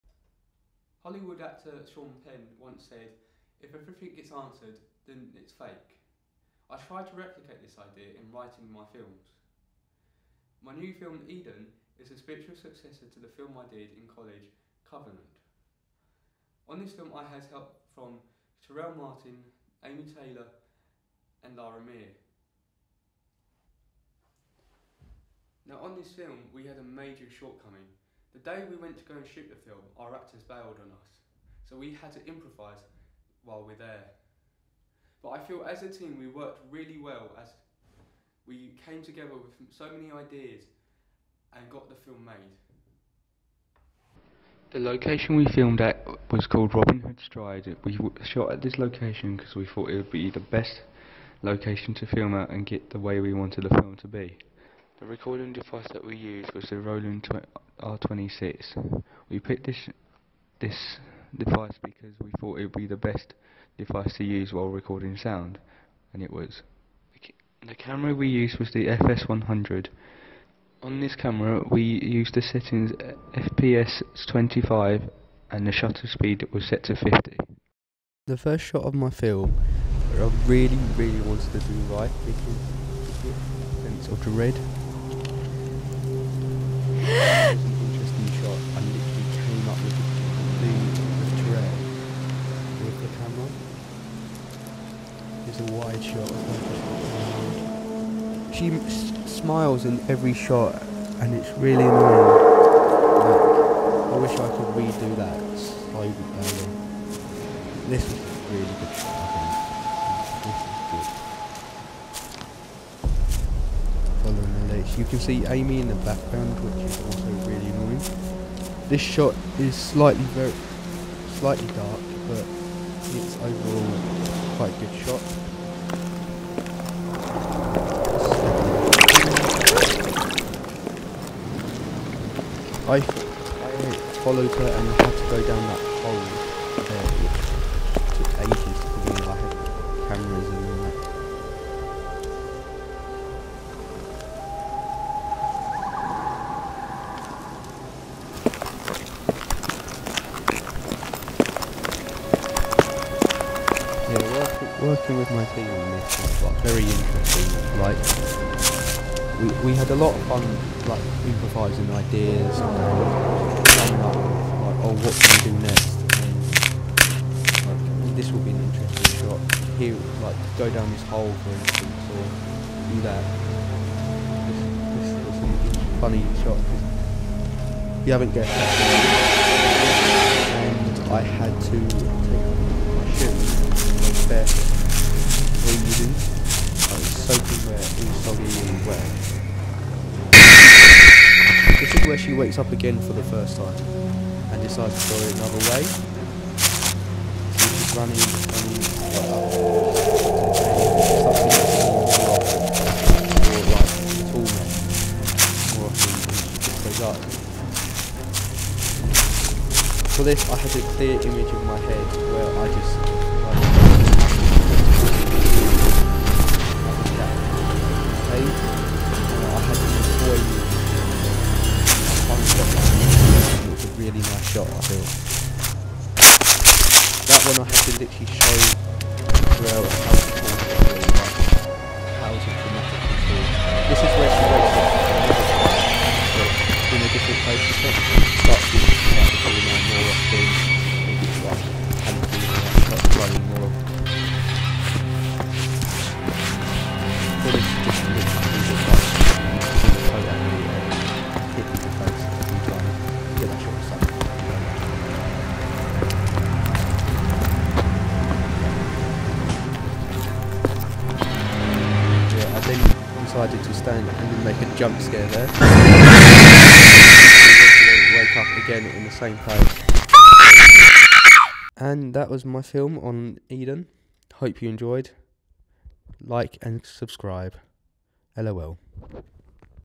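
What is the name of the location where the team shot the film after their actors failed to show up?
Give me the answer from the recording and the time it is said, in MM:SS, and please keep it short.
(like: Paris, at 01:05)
Robin Hood Stride, at 00:46.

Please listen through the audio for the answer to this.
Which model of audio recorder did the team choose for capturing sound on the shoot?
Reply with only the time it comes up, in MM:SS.
00:56.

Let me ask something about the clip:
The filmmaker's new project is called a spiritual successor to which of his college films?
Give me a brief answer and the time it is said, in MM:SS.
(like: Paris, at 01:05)
Covenant, at 00:14.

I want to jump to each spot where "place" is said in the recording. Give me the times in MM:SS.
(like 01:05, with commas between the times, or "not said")
03:57, 04:29.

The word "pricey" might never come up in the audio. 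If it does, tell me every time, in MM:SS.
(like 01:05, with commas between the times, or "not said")
not said.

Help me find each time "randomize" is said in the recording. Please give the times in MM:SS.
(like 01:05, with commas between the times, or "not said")
not said.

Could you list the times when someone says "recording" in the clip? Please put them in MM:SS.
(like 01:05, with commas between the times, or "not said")
00:55, 01:04.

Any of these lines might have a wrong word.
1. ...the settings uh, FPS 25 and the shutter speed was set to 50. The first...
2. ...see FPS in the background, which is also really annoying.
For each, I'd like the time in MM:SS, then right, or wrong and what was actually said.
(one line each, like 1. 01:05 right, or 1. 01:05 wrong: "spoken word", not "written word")
1. 01:12 right
2. 01:55 wrong: "Amy", not "FPS".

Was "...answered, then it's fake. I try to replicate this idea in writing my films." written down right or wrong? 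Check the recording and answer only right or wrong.
right.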